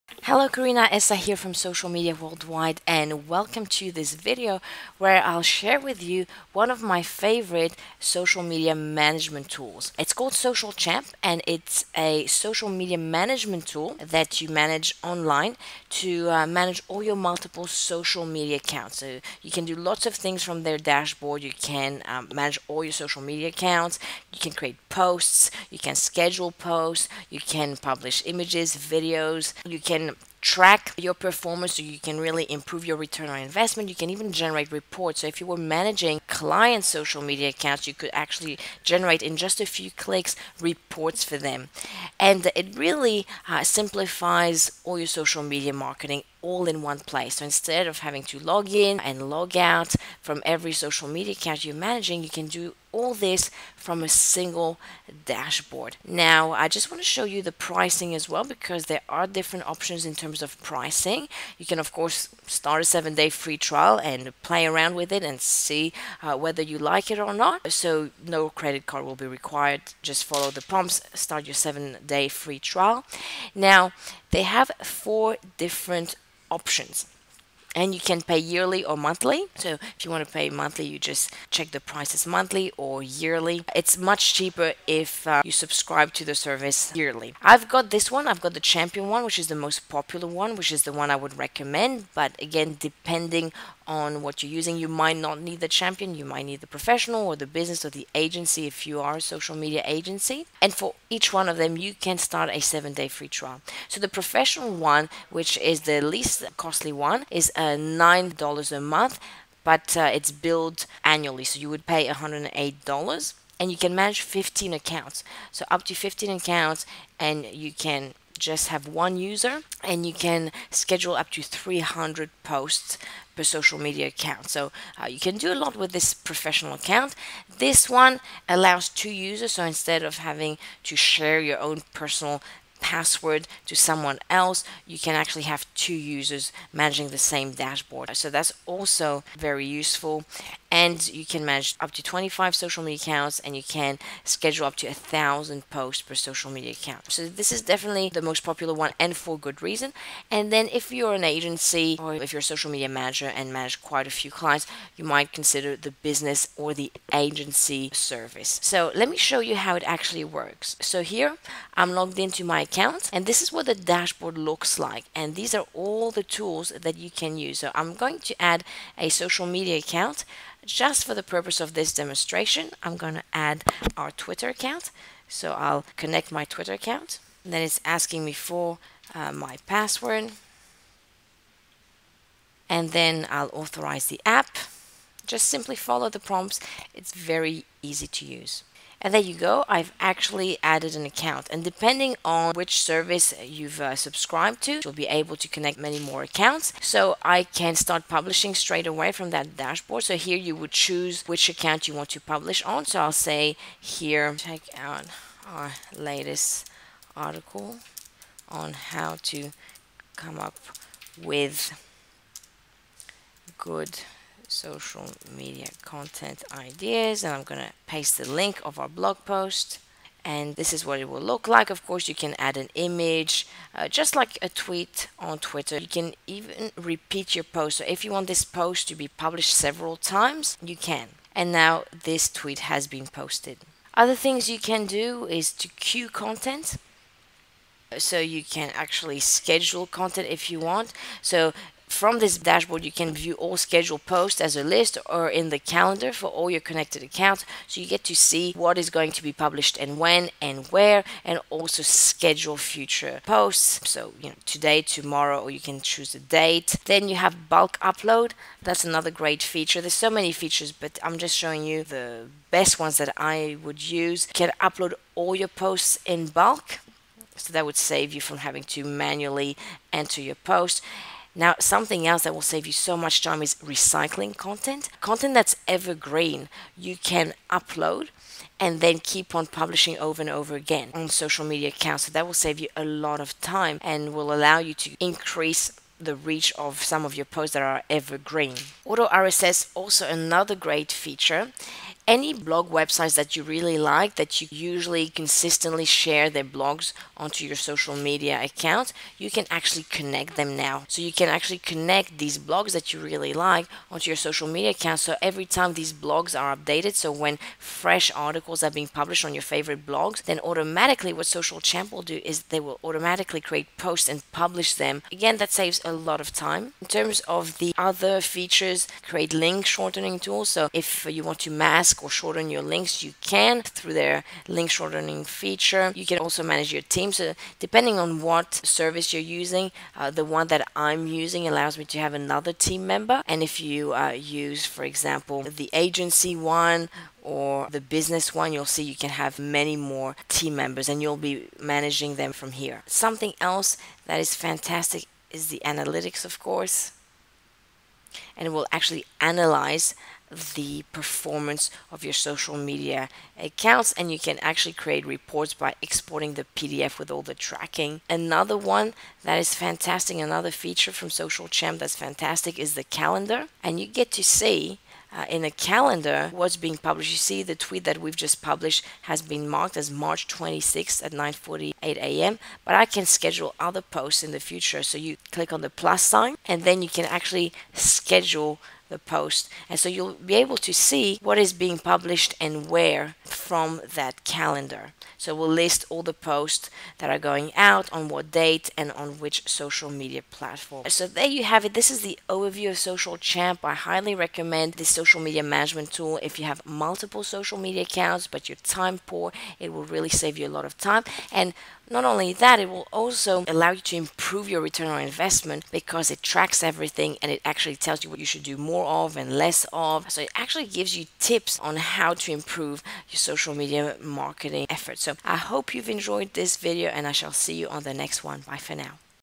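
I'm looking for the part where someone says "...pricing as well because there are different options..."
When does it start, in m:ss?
0:57.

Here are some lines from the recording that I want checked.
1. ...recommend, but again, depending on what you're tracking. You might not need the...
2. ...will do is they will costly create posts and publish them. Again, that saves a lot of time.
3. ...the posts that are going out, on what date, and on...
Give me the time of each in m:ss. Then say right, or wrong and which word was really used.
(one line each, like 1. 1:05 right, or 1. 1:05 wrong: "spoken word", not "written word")
1. 1:31 wrong: "using", not "tracking"
2. 5:11 wrong: "automatically", not "costly"
3. 6:26 right.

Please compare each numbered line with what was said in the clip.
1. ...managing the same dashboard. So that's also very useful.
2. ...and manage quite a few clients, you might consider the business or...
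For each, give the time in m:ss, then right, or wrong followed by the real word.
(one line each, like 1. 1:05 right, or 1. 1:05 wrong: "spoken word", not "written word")
1. 2:16 right
2. 2:33 right.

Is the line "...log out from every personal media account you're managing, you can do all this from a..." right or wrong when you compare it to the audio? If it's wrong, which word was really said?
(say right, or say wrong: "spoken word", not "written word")
wrong: "social", not "personal".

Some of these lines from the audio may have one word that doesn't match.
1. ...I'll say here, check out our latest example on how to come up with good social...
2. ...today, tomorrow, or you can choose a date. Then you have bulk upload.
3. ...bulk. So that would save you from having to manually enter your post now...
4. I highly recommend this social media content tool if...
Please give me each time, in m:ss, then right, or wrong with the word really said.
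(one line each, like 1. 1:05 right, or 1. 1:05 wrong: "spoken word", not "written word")
1. 3:23 wrong: "article", not "example"
2. 4:14 right
3. 4:26 right
4. 6:33 wrong: "management", not "content".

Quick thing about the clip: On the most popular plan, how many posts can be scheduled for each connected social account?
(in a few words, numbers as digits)
1000.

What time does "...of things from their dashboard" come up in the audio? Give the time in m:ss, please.
0:20.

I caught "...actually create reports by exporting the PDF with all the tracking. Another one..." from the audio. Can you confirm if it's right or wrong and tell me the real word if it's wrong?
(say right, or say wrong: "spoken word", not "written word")
right.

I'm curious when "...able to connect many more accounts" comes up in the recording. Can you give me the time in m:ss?
3:15.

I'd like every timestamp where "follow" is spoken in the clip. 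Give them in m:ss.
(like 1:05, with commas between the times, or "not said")
1:10, 3:05.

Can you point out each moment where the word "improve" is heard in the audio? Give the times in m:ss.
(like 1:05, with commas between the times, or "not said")
0:32, 6:43, 6:52.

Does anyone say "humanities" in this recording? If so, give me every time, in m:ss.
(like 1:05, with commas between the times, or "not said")
not said.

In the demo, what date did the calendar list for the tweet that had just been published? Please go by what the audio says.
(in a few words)
March 26th.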